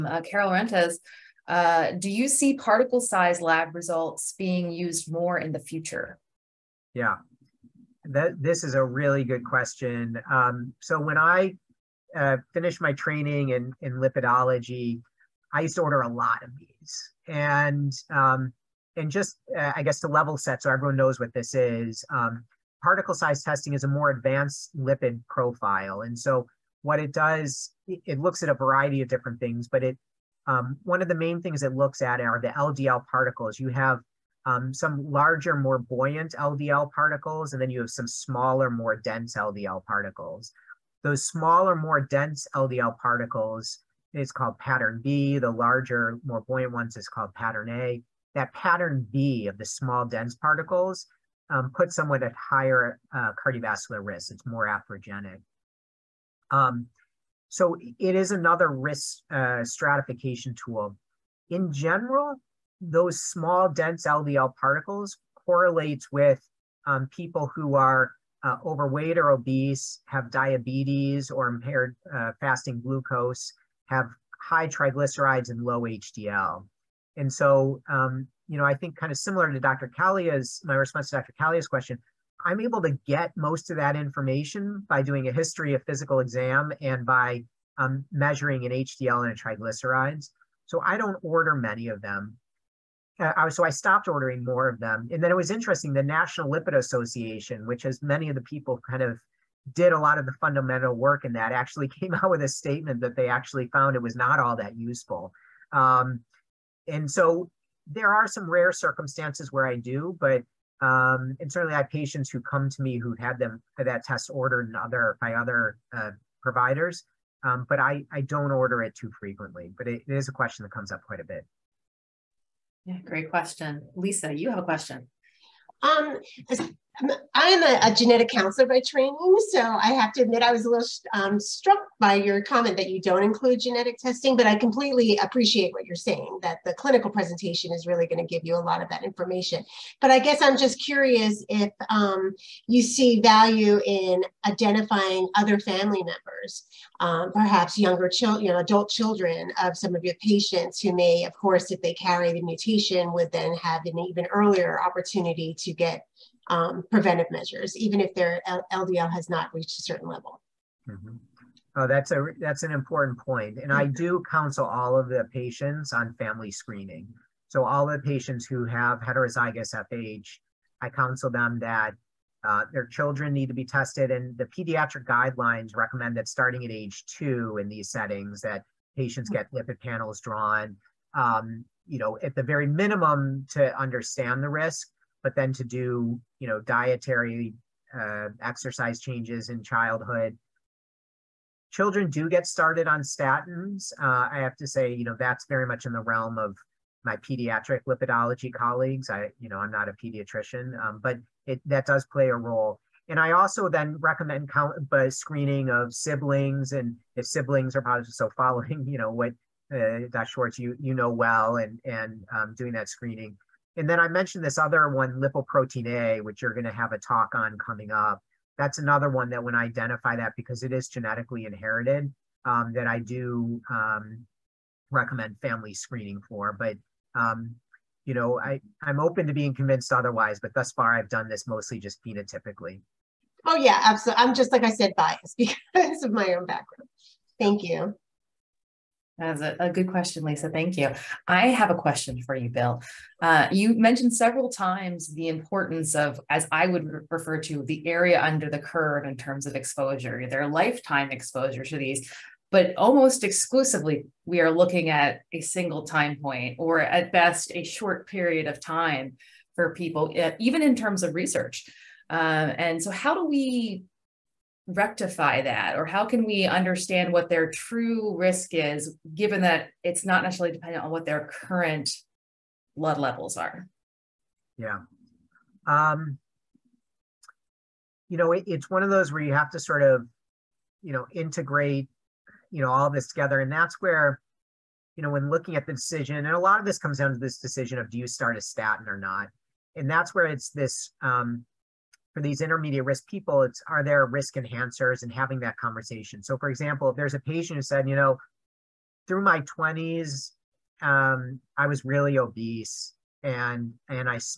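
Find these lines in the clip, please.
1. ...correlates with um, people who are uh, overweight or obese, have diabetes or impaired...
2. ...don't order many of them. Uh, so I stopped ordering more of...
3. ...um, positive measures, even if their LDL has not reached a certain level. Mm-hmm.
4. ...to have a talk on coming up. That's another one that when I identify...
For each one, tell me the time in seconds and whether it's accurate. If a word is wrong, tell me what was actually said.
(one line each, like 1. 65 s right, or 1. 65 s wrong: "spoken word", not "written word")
1. 65 s right
2. 90 s right
3. 156 s wrong: "preventive", not "positive"
4. 216 s right.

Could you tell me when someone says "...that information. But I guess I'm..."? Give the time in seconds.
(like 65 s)
138 s.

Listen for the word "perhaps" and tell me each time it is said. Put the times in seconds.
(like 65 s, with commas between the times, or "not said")
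147 s.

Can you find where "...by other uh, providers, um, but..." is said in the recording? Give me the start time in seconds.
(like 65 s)
115 s.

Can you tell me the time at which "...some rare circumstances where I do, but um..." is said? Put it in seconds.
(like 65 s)
108 s.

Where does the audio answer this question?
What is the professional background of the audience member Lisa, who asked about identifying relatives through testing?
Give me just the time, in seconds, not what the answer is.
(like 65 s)
127 s.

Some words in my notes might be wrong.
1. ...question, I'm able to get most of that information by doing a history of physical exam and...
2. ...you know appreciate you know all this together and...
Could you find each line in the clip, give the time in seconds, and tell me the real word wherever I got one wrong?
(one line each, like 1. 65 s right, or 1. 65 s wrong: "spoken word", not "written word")
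1. 81 s right
2. 280 s wrong: "integrate", not "appreciate".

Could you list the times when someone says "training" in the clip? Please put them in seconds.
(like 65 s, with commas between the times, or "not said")
12 s, 128 s.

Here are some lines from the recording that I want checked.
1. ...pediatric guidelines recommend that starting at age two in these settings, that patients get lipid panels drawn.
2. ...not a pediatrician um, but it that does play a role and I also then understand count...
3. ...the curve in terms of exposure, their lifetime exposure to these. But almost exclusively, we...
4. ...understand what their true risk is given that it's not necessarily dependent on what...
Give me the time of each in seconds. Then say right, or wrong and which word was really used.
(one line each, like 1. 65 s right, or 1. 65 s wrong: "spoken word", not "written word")
1. 174 s right
2. 199 s wrong: "recommend", not "understand"
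3. 248 s right
4. 266 s right.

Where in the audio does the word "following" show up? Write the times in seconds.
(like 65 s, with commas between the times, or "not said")
208 s.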